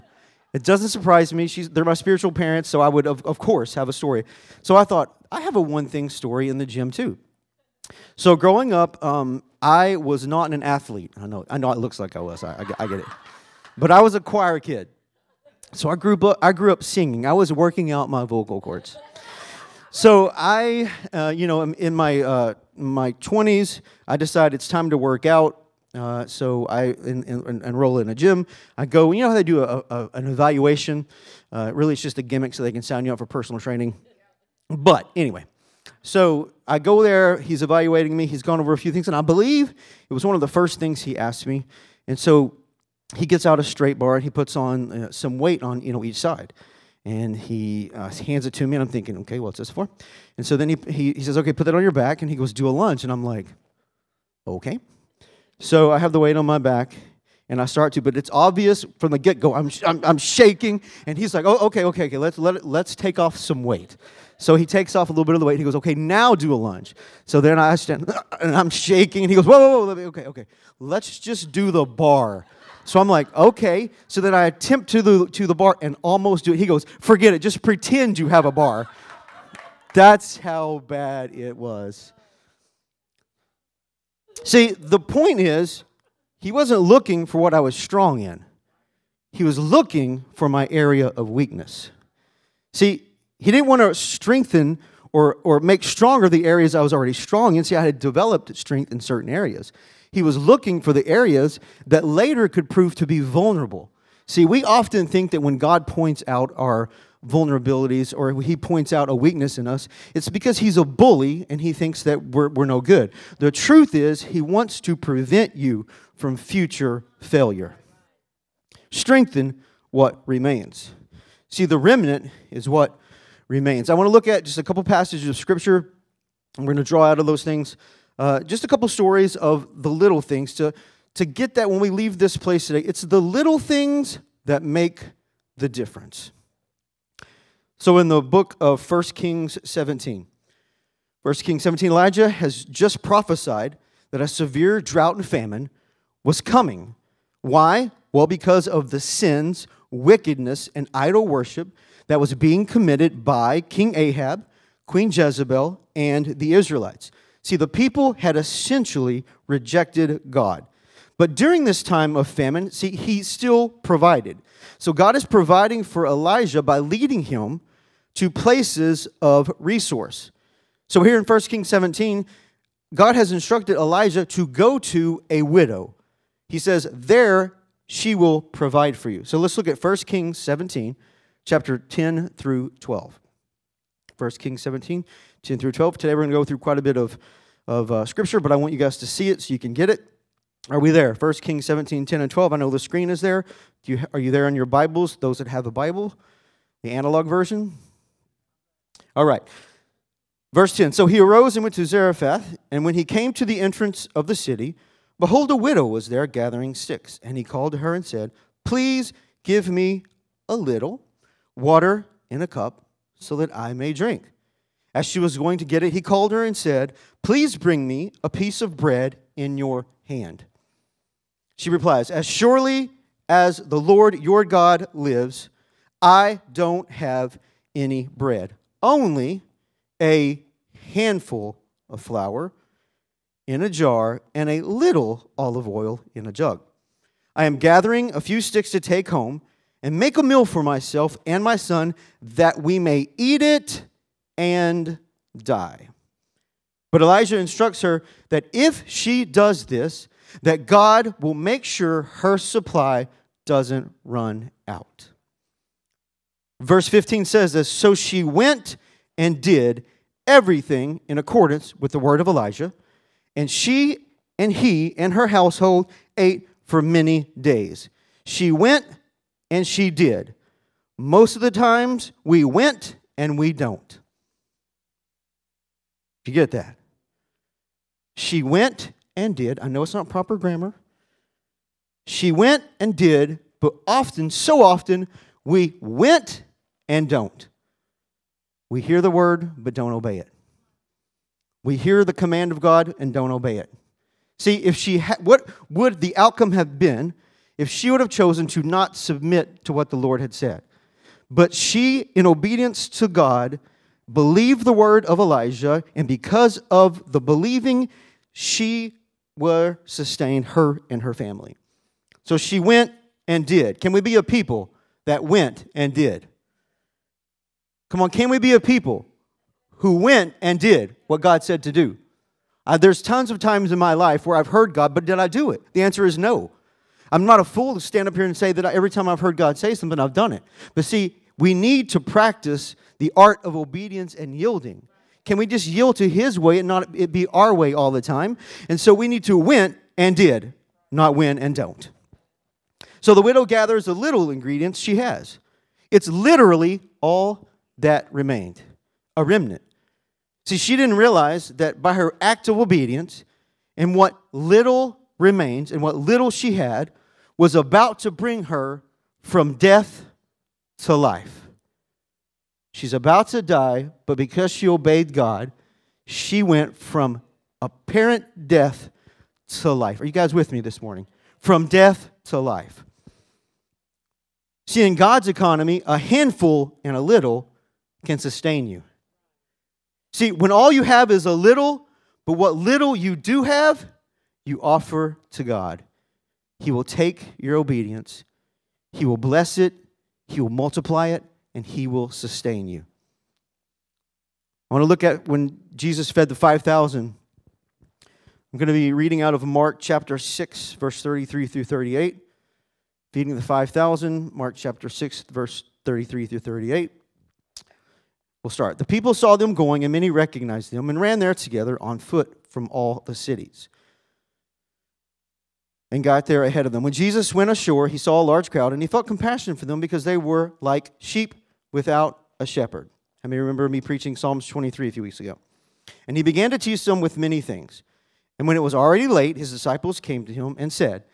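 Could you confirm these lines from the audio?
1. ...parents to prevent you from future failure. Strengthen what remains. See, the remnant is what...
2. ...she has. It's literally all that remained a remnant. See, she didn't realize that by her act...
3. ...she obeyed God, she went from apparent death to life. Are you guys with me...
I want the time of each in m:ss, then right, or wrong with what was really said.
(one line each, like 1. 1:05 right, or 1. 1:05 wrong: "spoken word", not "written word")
1. 1:54 wrong: "wants", not "parents"
2. 5:44 right
3. 6:04 right.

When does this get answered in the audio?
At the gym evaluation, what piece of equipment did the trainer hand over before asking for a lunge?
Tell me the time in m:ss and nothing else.
0:43.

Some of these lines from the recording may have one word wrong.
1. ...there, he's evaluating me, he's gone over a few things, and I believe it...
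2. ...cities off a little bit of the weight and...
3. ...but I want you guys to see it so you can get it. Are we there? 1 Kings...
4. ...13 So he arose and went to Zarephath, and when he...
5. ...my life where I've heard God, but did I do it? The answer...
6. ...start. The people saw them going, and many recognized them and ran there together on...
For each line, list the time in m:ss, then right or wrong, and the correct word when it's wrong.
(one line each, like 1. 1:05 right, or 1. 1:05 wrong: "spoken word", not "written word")
1. 0:37 right
2. 1:04 wrong: "takes", not "cities"
3. 3:08 right
4. 3:20 wrong: "10", not "13"
5. 5:23 right
6. 6:48 right.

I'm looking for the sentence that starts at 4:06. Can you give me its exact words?
But Elijah instructs her that if she does this, that God will make sure her supply doesn't run out.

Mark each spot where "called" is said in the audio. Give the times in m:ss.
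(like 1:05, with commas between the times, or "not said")
3:27, 3:36.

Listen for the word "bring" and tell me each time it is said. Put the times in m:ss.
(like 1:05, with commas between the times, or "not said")
3:37, 5:58.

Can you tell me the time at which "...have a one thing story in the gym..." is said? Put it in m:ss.
0:05.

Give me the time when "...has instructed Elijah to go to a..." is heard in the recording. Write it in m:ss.
2:53.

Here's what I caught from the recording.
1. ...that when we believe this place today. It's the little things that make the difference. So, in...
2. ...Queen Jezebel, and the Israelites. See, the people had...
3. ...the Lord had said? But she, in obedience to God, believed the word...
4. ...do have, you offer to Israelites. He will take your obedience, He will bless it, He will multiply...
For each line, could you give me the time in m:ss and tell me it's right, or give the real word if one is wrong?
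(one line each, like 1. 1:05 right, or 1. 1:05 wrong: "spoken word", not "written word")
1. 2:11 wrong: "leave", not "believe"
2. 2:34 right
3. 4:59 right
4. 6:23 wrong: "God", not "Israelites".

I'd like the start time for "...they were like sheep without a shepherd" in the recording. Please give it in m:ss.
7:00.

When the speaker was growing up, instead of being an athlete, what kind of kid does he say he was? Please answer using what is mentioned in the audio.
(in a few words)
A choir kid.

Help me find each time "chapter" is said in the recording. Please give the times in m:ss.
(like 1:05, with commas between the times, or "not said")
3:01, 6:39, 6:44.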